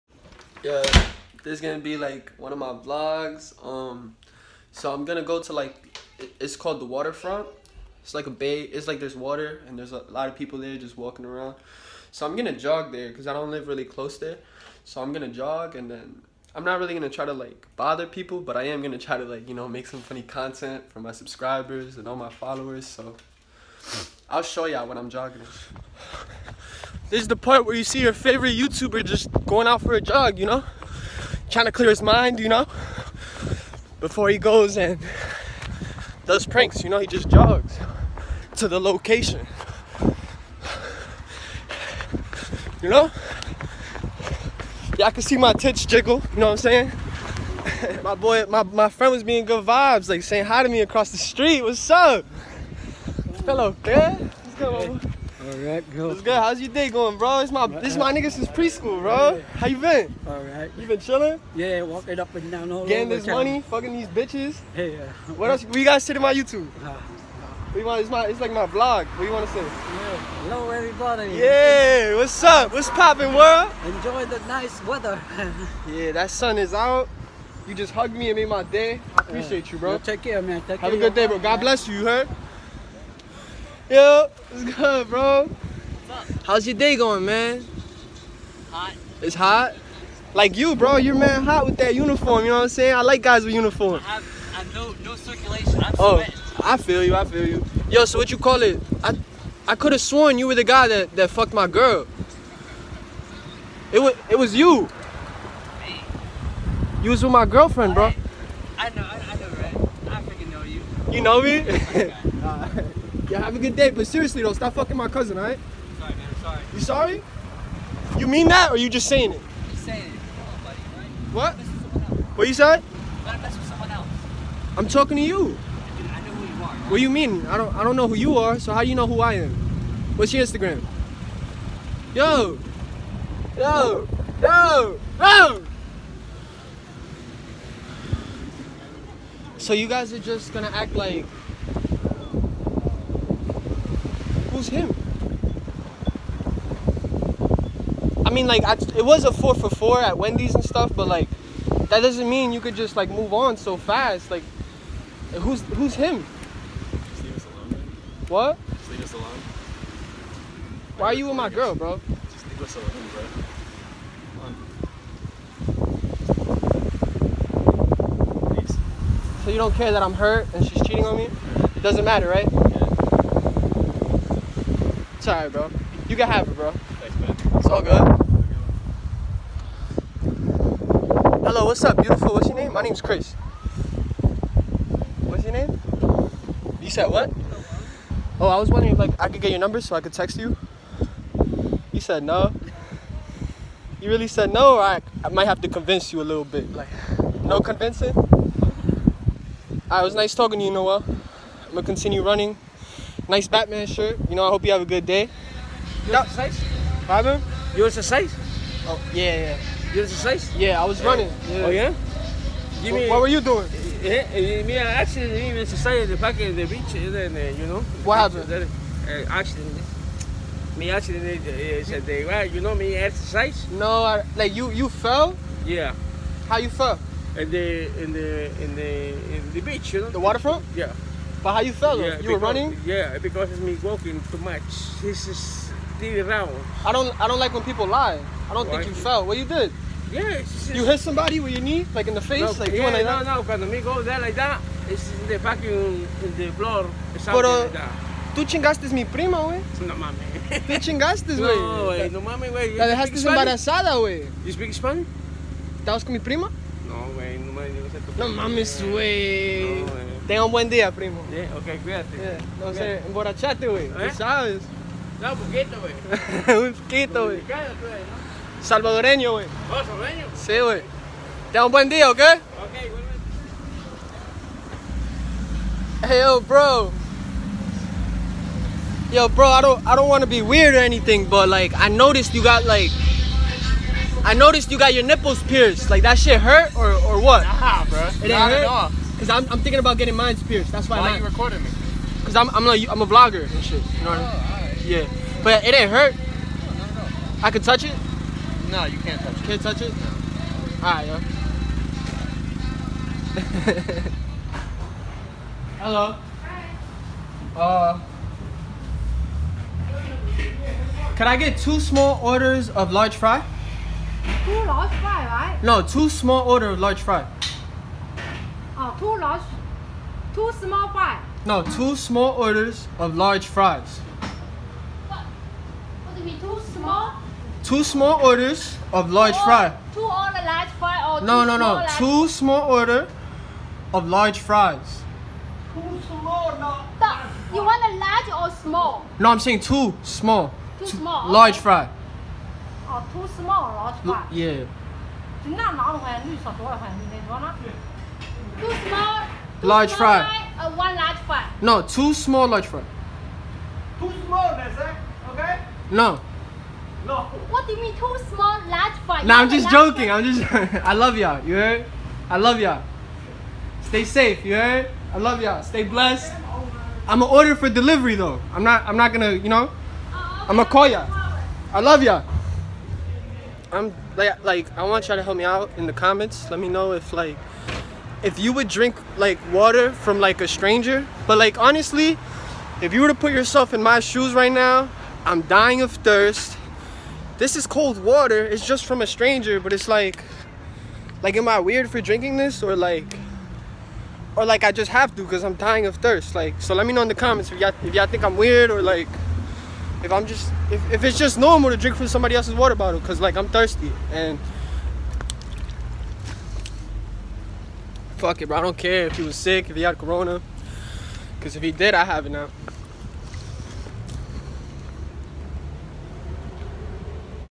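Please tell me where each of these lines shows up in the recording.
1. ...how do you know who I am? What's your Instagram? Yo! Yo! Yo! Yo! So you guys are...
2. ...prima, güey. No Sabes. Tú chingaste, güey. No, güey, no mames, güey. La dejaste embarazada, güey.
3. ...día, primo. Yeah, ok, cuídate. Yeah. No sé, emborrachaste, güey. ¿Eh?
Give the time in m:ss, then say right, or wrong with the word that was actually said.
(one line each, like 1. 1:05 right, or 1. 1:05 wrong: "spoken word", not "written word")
1. 2:08 right
2. 4:09 wrong: "mames", not "Sabes"
3. 4:20 right.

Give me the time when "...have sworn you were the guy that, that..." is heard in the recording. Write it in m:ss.
1:39.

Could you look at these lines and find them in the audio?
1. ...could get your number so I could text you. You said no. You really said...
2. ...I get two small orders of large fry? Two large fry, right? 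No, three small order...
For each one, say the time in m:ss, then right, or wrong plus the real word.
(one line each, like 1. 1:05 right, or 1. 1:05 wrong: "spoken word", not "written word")
1. 3:09 right
2. 5:11 wrong: "two", not "three".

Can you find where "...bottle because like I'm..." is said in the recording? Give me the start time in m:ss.
6:42.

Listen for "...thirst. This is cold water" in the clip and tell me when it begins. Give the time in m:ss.
6:25.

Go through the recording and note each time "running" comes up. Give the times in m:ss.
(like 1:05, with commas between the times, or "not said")
3:22, 3:31, 3:52.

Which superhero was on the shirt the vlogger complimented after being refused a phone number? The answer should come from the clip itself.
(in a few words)
Batman.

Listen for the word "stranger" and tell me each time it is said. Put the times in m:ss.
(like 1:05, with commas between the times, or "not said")
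6:20, 6:29.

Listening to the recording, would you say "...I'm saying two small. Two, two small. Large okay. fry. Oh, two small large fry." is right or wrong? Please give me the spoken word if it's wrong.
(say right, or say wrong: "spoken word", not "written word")
right.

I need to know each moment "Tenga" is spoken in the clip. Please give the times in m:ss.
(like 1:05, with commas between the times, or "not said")
4:20, 4:31.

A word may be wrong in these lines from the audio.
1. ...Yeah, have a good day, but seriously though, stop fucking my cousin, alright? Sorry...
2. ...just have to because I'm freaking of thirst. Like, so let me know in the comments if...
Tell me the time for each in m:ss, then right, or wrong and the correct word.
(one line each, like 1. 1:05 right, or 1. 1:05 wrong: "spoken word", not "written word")
1. 1:53 right
2. 6:34 wrong: "dying", not "freaking".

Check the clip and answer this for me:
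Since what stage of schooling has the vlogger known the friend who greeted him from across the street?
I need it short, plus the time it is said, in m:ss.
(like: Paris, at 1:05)
preschool, at 0:58.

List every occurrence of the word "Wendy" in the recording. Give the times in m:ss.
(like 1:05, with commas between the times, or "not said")
2:30.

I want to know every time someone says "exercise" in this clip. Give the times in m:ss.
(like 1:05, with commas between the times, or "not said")
3:42.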